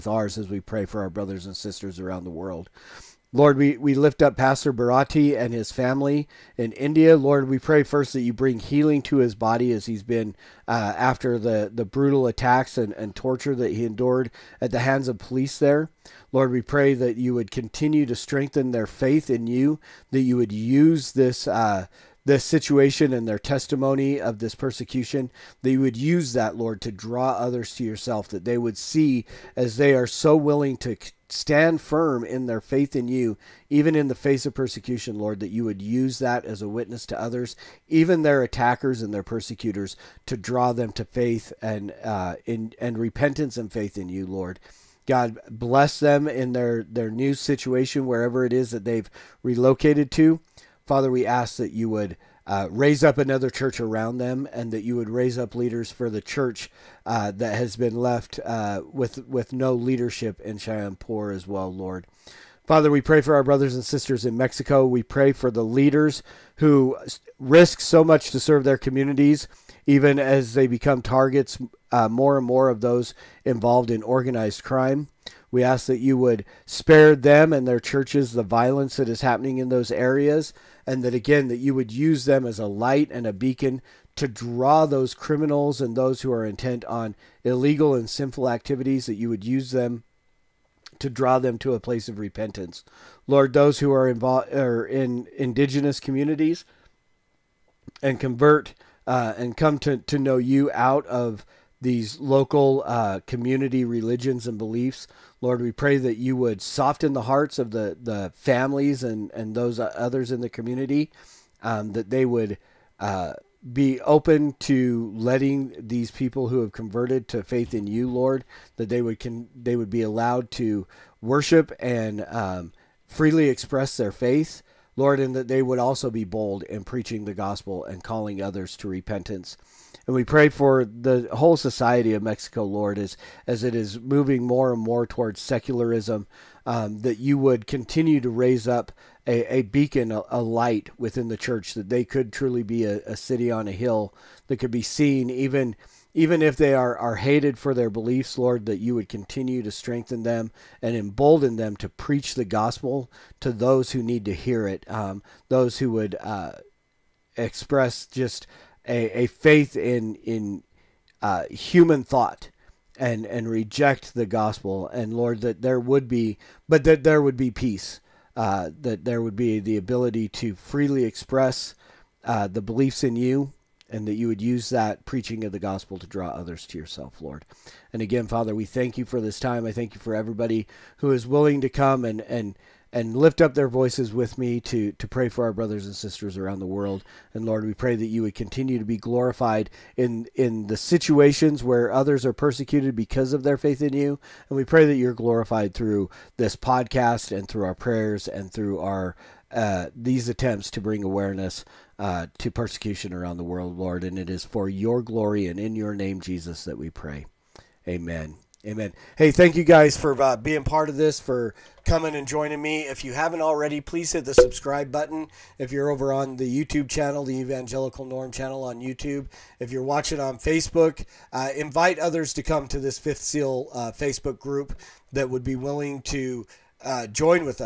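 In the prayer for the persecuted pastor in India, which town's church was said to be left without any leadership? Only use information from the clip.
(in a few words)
Shyampur.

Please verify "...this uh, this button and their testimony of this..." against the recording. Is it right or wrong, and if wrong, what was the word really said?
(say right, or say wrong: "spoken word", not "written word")
wrong: "situation", not "button".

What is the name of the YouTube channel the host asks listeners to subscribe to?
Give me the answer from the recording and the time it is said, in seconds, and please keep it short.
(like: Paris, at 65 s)
Evangelical Norm, at 217 s.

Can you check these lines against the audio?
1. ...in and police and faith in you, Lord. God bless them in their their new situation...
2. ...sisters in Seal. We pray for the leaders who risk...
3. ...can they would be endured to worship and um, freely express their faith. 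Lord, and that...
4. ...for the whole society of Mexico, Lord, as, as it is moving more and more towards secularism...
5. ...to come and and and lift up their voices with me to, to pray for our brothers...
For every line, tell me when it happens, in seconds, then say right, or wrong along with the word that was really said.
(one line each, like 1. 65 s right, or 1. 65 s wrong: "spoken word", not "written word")
1. 42 s wrong: "repentance", not "police"
2. 63 s wrong: "Mexico", not "Seal"
3. 119 s wrong: "allowed", not "endured"
4. 130 s right
5. 181 s right.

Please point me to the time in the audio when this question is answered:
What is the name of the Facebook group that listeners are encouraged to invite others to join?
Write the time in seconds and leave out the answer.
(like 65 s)
222 s.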